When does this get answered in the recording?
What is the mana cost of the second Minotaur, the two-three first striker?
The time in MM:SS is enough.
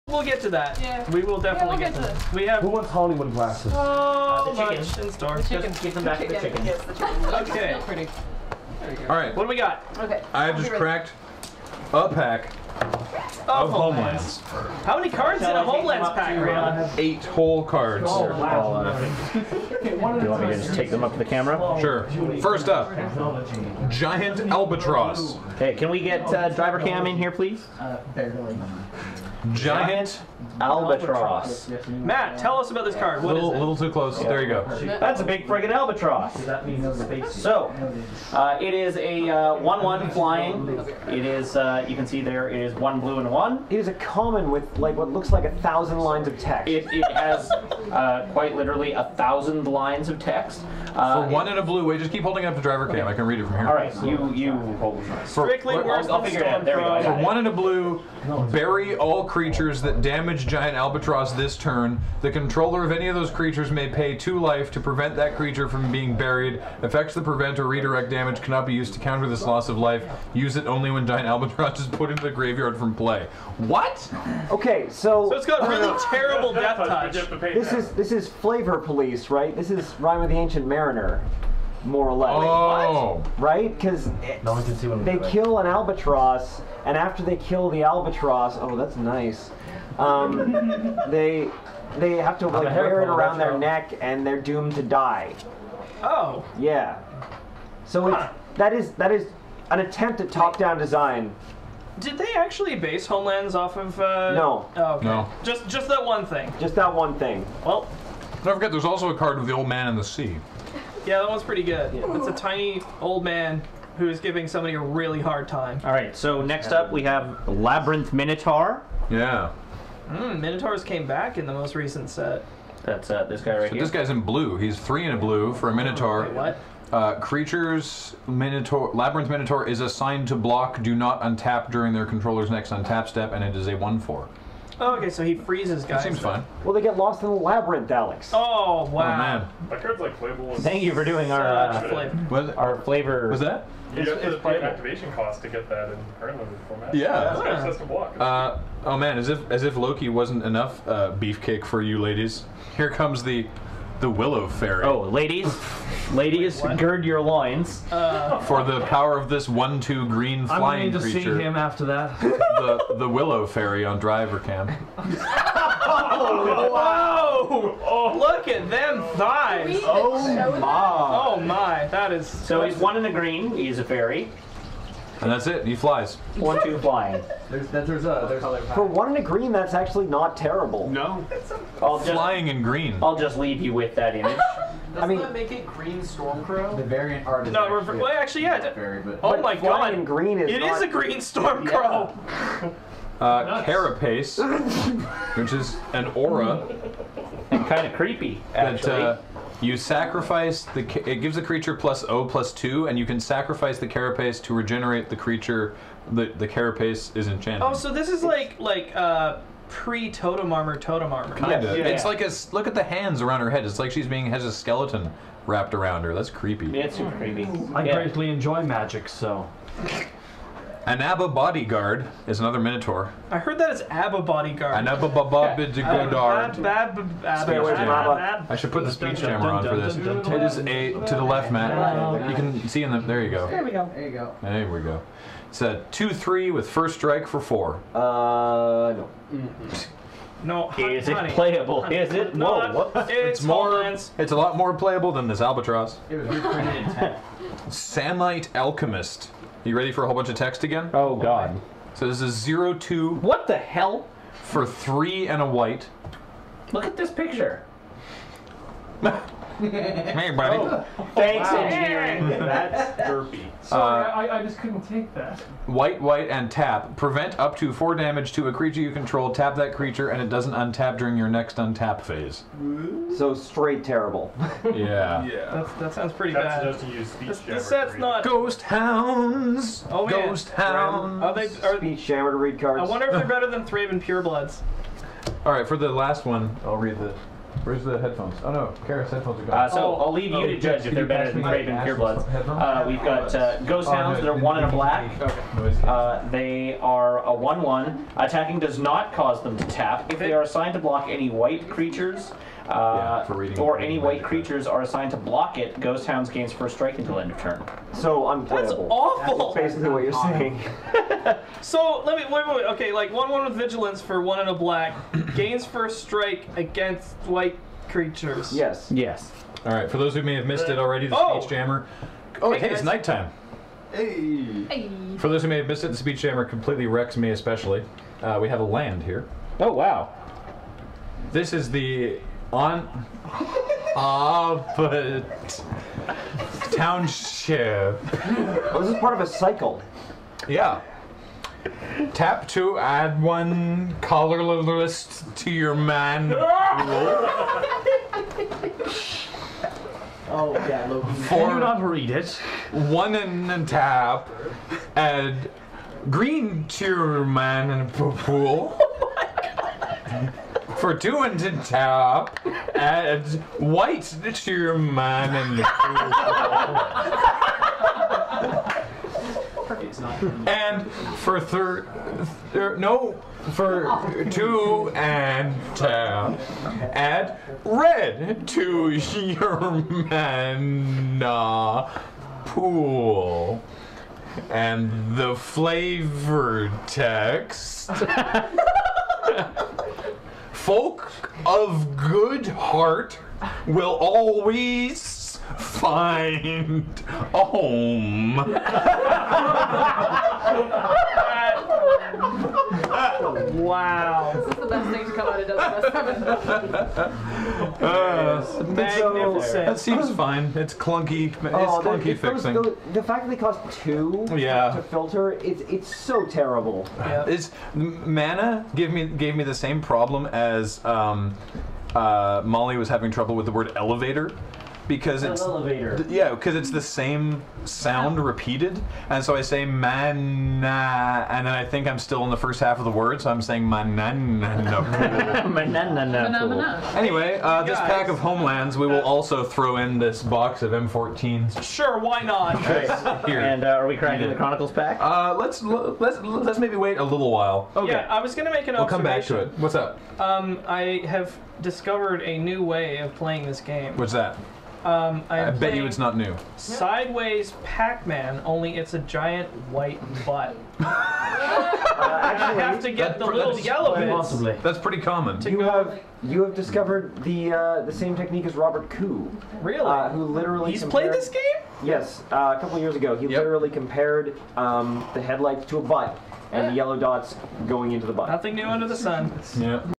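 03:57.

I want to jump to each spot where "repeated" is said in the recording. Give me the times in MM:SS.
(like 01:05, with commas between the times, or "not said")
07:08.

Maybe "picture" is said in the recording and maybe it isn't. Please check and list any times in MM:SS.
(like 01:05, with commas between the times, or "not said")
04:17.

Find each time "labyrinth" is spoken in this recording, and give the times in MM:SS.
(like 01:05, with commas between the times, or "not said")
01:57, 02:08, 02:17.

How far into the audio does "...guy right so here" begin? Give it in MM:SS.
02:03.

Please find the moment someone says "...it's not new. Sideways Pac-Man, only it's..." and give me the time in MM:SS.
07:35.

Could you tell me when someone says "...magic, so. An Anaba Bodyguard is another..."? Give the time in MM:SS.
03:38.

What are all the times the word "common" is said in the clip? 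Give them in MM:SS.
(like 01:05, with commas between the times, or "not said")
00:43, 07:45.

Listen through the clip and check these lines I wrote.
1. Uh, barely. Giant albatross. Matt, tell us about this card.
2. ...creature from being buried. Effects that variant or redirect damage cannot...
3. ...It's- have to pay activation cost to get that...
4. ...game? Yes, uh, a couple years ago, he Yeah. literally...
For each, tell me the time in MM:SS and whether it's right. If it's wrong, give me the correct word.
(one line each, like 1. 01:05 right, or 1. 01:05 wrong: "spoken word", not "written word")
1. 00:27 right
2. 01:05 wrong: "prevent", not "variant"
3. 02:24 right
4. 07:51 wrong: "Yep", not "Yeah".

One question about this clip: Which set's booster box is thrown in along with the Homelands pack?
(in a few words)
M14.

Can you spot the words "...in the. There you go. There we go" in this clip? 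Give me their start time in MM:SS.
03:52.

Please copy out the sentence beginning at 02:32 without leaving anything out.
Here comes the the Willow Faerie.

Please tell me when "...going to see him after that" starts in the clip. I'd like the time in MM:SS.
02:40.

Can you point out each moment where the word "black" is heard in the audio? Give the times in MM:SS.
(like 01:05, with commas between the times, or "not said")
04:54, 05:14.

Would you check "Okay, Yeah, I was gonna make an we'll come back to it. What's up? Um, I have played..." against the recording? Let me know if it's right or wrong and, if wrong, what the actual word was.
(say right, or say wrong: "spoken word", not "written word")
wrong: "discovered", not "played".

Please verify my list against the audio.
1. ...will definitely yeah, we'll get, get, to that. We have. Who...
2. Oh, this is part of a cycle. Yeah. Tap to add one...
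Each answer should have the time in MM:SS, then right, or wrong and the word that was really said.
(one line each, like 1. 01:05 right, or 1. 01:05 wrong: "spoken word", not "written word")
1. 00:01 right
2. 05:38 right.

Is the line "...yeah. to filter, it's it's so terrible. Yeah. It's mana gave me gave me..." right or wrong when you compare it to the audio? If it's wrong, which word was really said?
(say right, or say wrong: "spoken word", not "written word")
right.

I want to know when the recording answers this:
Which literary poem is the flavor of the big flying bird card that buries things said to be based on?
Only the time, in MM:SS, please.
01:19.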